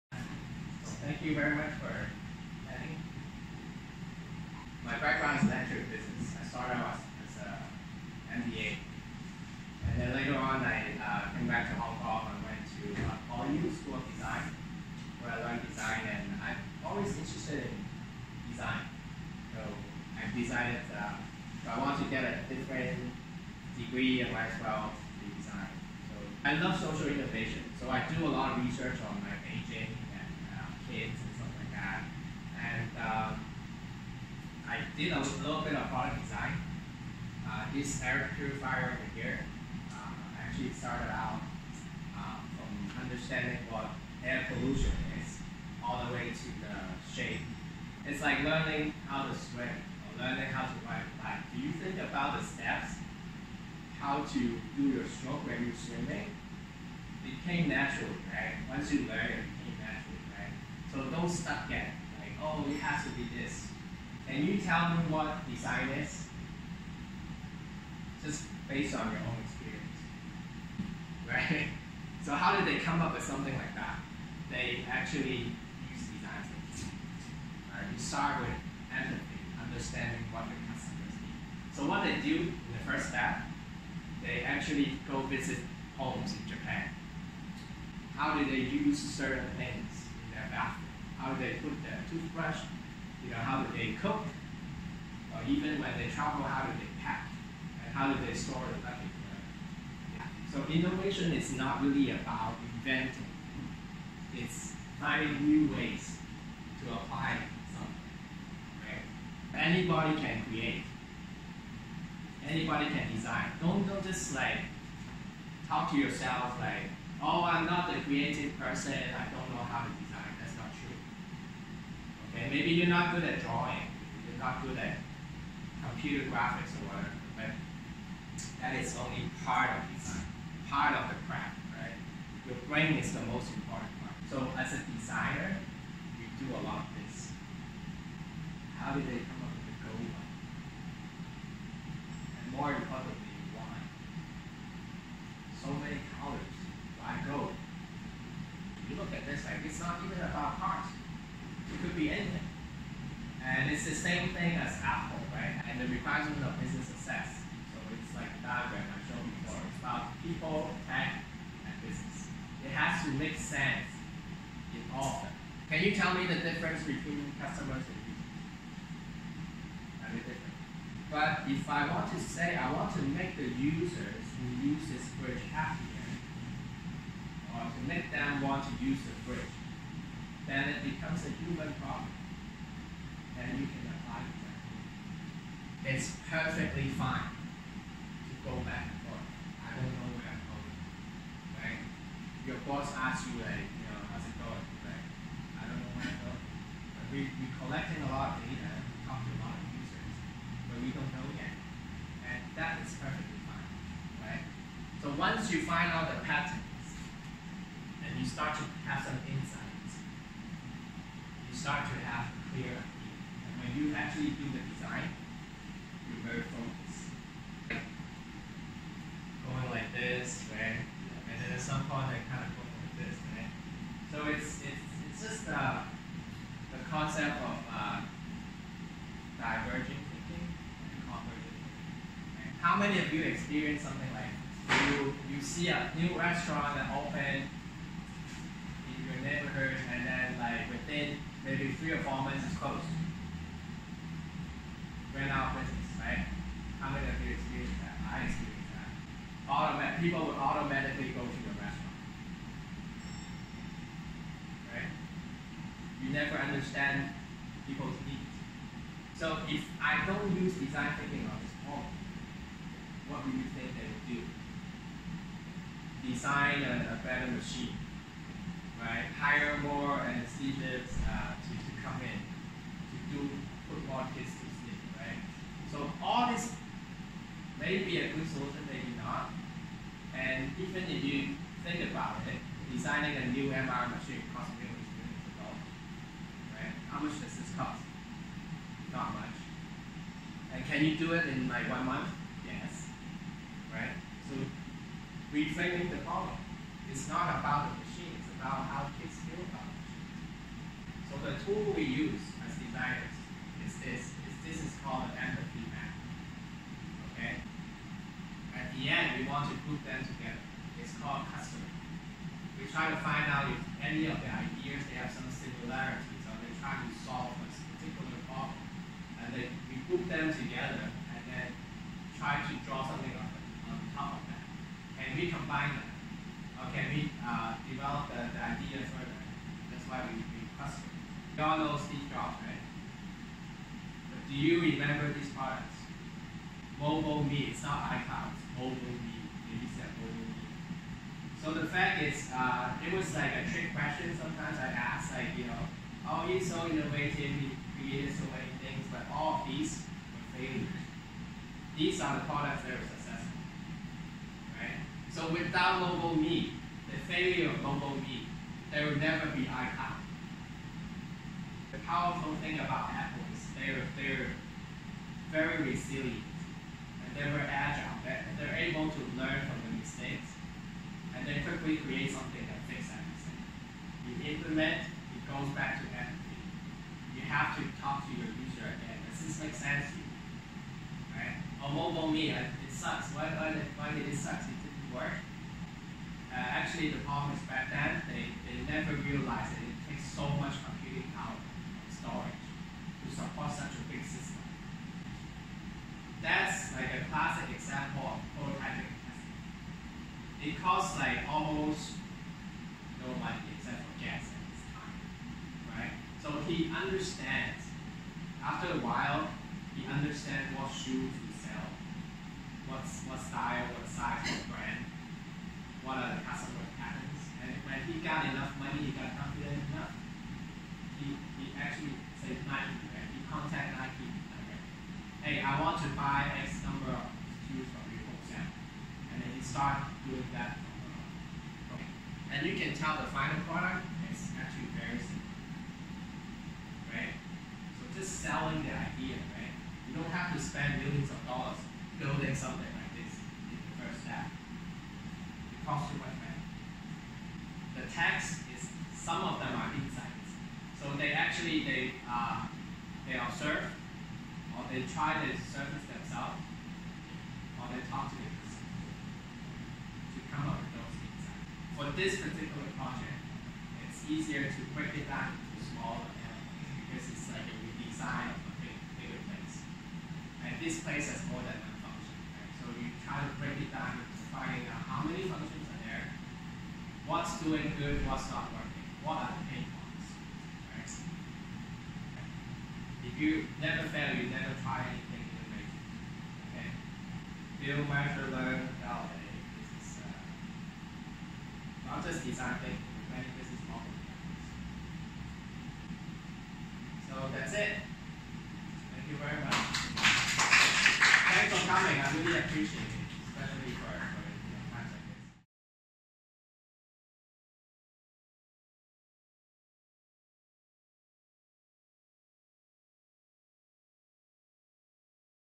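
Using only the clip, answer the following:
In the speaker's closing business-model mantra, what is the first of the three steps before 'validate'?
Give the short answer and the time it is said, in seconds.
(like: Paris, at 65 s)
Build, at 487 s.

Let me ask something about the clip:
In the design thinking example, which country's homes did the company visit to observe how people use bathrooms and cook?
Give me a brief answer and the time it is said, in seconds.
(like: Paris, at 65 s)
Japan, at 86 s.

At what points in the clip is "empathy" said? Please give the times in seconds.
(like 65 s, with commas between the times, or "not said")
78 s, 305 s, 375 s.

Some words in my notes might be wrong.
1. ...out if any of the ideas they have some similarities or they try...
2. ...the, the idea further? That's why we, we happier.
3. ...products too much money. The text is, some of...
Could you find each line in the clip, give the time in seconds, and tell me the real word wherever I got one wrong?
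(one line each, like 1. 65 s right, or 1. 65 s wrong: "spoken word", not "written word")
1. 313 s right
2. 328 s wrong: "customer", not "happier"
3. 445 s wrong: "costs", not "products".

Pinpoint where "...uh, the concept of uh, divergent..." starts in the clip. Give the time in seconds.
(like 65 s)
225 s.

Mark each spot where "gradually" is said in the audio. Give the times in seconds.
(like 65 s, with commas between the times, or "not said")
not said.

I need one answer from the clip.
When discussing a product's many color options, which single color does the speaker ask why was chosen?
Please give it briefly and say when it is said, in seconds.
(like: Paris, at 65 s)
Gold, at 147 s.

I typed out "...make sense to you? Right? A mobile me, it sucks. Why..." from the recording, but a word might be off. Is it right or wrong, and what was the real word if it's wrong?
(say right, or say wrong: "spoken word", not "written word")
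right.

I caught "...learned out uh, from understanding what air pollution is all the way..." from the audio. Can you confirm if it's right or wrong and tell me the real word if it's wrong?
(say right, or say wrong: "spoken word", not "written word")
wrong: "started", not "learned".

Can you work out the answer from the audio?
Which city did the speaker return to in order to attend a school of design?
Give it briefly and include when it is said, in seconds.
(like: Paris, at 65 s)
Hong Kong, at 11 s.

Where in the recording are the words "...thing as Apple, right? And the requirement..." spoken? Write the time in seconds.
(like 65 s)
154 s.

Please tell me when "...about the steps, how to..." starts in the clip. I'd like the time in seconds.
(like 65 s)
51 s.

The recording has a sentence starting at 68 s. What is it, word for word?
Just based on your own experience, right?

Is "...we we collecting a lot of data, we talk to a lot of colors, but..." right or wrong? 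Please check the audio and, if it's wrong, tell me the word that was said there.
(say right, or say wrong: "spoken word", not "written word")
wrong: "users", not "colors".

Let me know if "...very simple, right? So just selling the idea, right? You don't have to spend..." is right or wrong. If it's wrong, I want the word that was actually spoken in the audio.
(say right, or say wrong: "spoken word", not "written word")
right.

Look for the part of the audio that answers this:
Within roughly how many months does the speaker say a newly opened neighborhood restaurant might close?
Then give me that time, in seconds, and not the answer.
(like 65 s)
241 s.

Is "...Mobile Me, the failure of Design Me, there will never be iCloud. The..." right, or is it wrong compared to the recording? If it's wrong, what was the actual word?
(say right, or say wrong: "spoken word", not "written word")
wrong: "Mobile", not "Design".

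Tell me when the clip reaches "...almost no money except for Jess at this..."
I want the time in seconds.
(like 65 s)
401 s.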